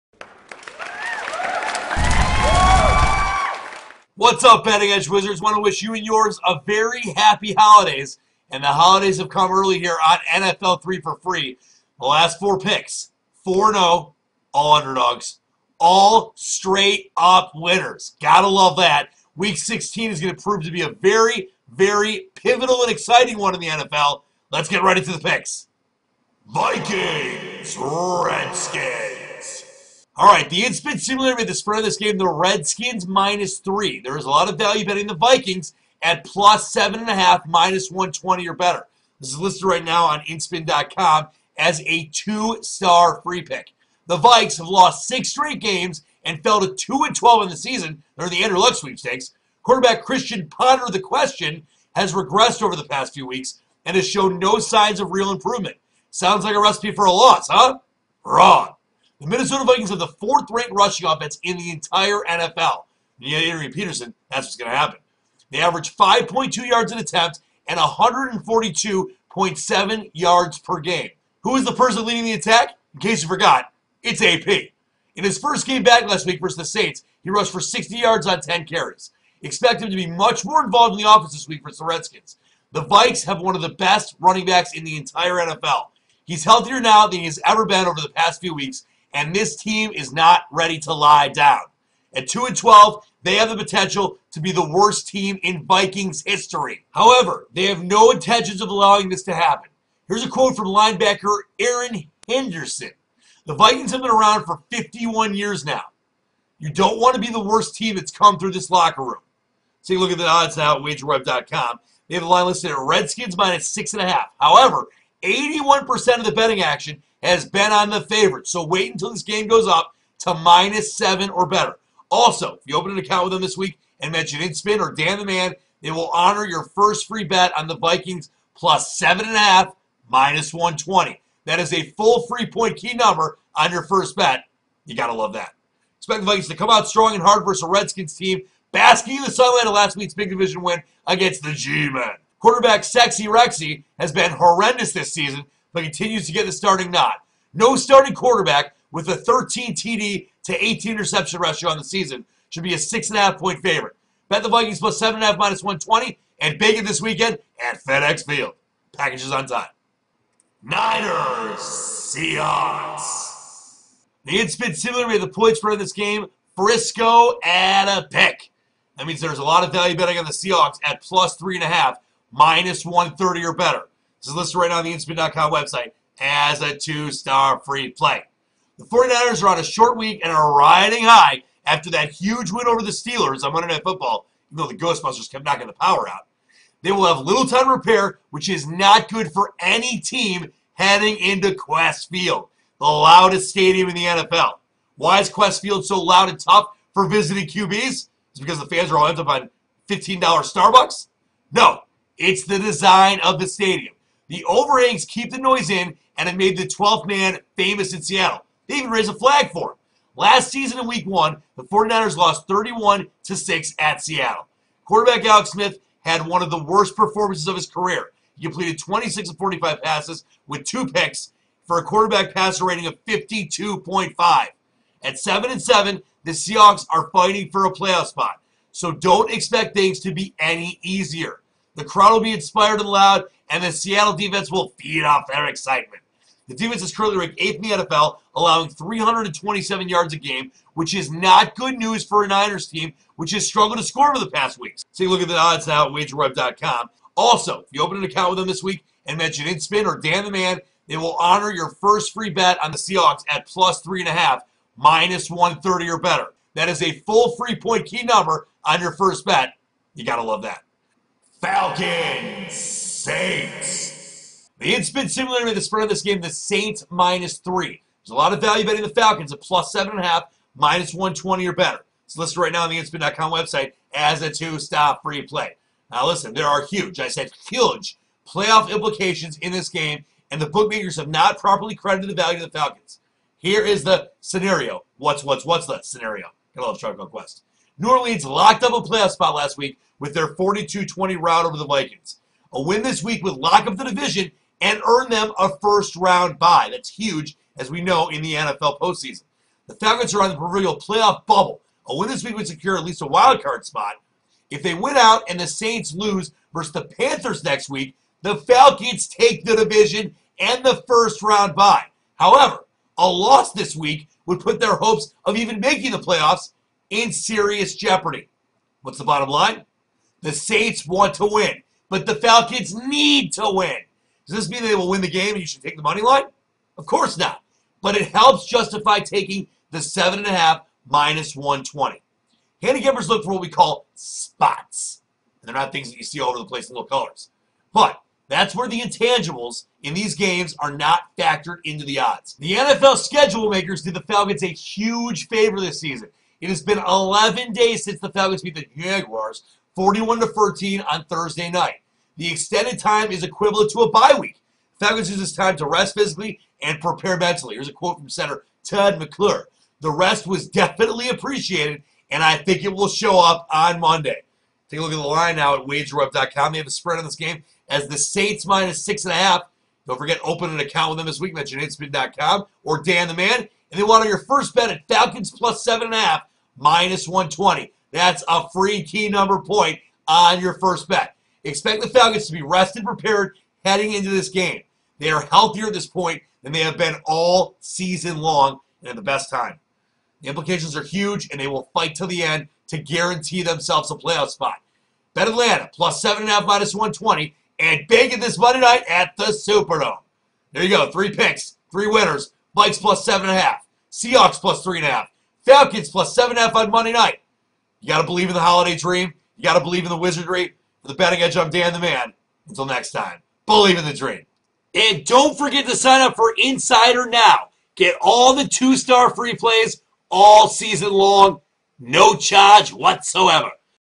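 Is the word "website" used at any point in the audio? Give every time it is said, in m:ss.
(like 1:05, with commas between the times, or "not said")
2:55, 4:33.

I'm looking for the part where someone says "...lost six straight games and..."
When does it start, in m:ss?
0:44.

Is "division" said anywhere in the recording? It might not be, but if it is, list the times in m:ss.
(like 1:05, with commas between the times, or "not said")
2:20, 4:53, 5:09.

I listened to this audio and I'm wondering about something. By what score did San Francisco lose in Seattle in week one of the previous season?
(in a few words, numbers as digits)
31 to 6.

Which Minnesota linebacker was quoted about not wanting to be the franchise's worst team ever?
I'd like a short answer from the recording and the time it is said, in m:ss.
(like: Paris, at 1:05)
Erin Henderson, at 1:41.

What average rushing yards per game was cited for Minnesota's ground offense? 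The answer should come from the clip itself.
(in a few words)
142.7.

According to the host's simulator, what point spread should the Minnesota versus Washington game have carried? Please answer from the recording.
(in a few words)
Redskins -3.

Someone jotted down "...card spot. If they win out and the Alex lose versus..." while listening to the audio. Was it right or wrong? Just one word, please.
wrong.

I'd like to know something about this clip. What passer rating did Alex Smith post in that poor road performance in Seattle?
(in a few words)
52.5.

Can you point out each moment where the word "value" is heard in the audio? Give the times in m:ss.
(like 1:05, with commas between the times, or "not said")
0:34, 2:49, 4:28, 4:42.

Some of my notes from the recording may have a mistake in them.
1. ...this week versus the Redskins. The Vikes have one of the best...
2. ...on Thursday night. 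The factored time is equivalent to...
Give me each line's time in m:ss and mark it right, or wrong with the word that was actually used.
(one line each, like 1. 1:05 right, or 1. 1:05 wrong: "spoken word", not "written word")
1. 1:21 right
2. 5:50 wrong: "extended", not "factored".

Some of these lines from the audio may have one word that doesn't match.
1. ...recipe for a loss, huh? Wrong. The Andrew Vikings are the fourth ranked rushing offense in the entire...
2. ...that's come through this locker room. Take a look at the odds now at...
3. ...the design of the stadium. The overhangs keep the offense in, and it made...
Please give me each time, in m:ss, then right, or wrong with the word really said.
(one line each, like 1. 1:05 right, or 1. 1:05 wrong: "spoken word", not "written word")
1. 0:56 wrong: "Minnesota", not "Andrew"
2. 1:47 right
3. 3:22 wrong: "noise", not "offense".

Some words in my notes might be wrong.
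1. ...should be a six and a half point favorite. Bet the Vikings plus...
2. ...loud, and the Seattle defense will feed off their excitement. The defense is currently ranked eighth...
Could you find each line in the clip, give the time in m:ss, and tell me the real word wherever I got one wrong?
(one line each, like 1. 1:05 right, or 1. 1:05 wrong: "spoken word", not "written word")
1. 2:32 right
2. 3:52 right.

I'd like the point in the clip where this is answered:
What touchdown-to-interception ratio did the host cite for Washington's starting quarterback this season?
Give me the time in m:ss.
2:29.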